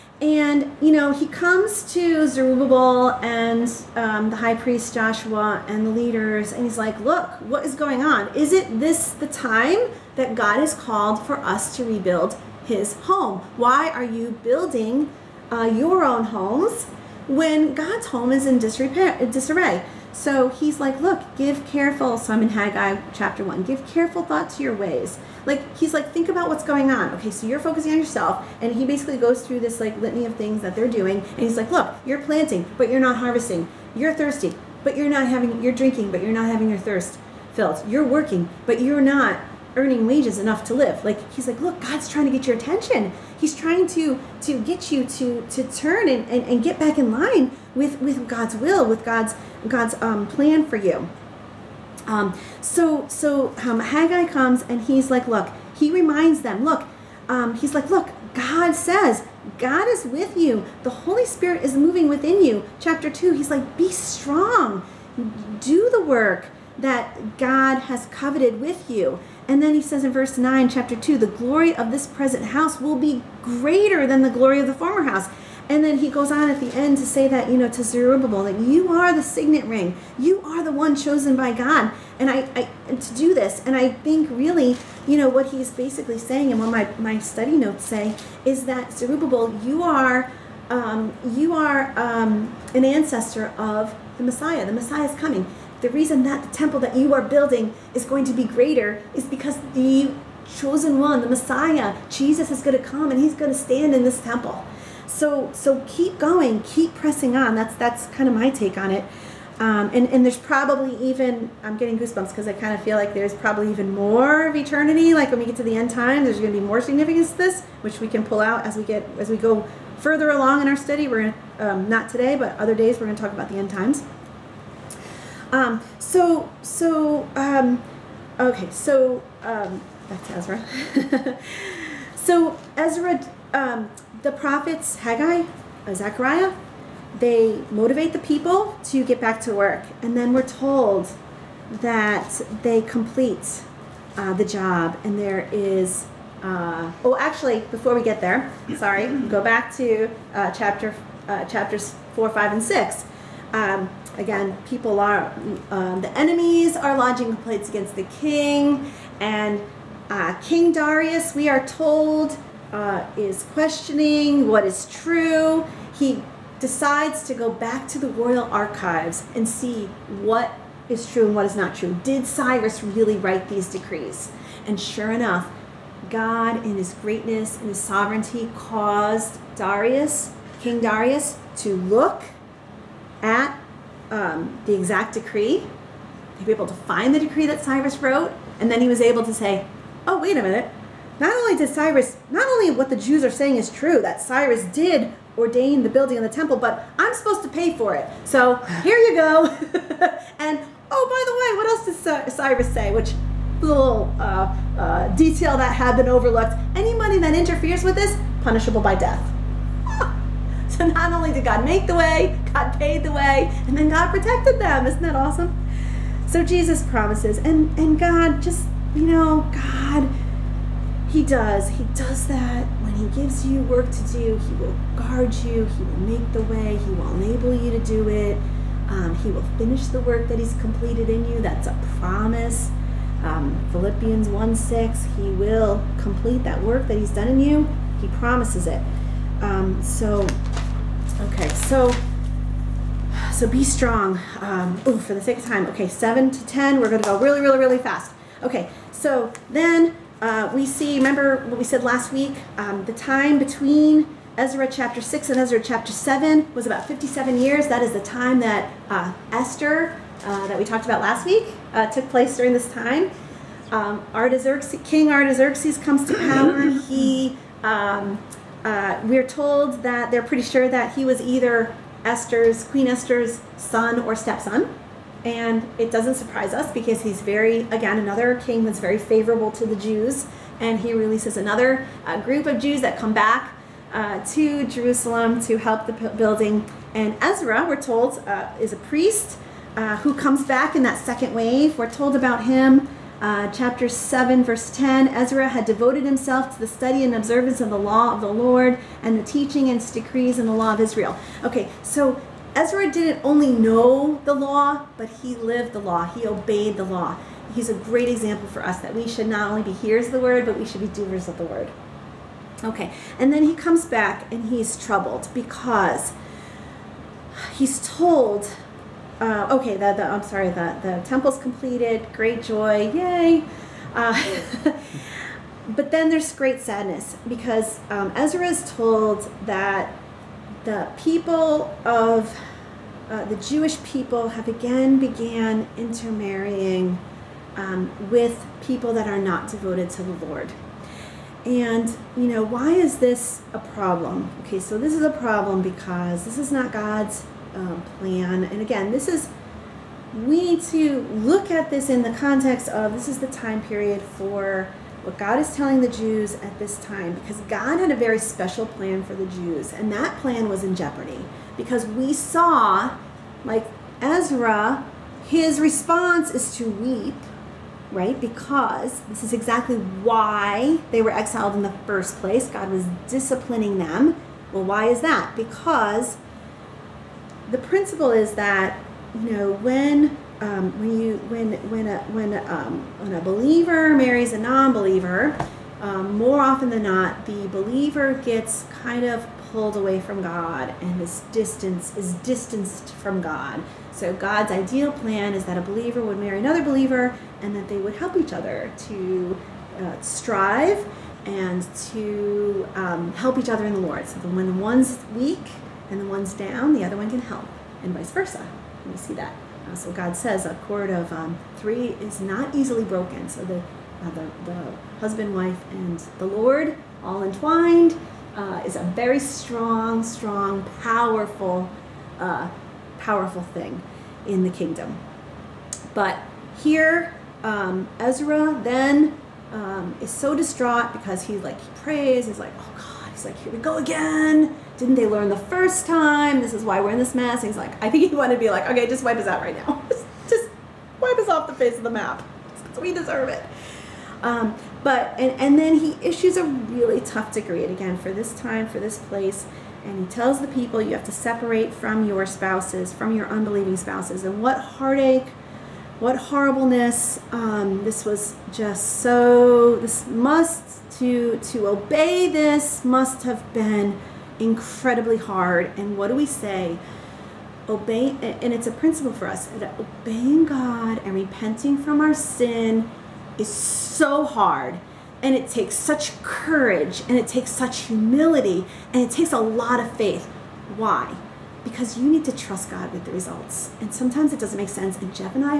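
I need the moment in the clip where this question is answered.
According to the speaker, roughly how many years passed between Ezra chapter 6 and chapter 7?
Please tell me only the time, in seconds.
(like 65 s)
256 s.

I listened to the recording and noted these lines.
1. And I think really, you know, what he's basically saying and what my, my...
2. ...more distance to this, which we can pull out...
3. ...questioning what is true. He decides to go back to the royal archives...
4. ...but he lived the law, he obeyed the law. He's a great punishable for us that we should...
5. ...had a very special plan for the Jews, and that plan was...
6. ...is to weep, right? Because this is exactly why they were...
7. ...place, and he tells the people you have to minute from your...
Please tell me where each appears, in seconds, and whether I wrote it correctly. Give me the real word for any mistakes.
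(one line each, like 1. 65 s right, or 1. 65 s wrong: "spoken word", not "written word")
1. 83 s right
2. 116 s wrong: "significance", not "distance"
3. 163 s right
4. 304 s wrong: "example", not "punishable"
5. 357 s right
6. 366 s right
7. 448 s wrong: "separate", not "minute".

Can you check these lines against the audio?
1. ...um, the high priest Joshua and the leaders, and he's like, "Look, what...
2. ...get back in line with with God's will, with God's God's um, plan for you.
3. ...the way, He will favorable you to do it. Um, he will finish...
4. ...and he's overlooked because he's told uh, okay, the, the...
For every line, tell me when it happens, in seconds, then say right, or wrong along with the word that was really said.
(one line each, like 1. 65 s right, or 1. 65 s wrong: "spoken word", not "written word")
1. 3 s right
2. 46 s right
3. 226 s wrong: "enable", not "favorable"
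4. 314 s wrong: "troubled", not "overlooked".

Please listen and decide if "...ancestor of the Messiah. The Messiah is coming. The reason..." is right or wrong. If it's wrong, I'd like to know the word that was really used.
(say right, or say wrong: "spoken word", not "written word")
right.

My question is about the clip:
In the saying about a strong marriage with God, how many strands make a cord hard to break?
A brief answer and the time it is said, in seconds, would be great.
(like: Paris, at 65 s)
3, at 411 s.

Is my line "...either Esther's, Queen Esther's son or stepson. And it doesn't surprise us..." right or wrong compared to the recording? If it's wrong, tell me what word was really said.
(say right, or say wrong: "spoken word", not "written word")
right.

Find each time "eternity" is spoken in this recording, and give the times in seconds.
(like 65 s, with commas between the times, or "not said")
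114 s.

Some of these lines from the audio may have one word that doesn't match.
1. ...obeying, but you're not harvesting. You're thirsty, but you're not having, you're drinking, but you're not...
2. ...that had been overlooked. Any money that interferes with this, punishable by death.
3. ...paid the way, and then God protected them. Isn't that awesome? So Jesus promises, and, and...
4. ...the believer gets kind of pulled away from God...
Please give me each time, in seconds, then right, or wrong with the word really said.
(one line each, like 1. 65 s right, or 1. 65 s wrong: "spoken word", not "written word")
1. 32 s wrong: "planting", not "obeying"
2. 205 s right
3. 212 s right
4. 387 s right.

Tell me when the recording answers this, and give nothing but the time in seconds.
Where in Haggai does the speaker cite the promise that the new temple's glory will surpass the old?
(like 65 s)
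70 s.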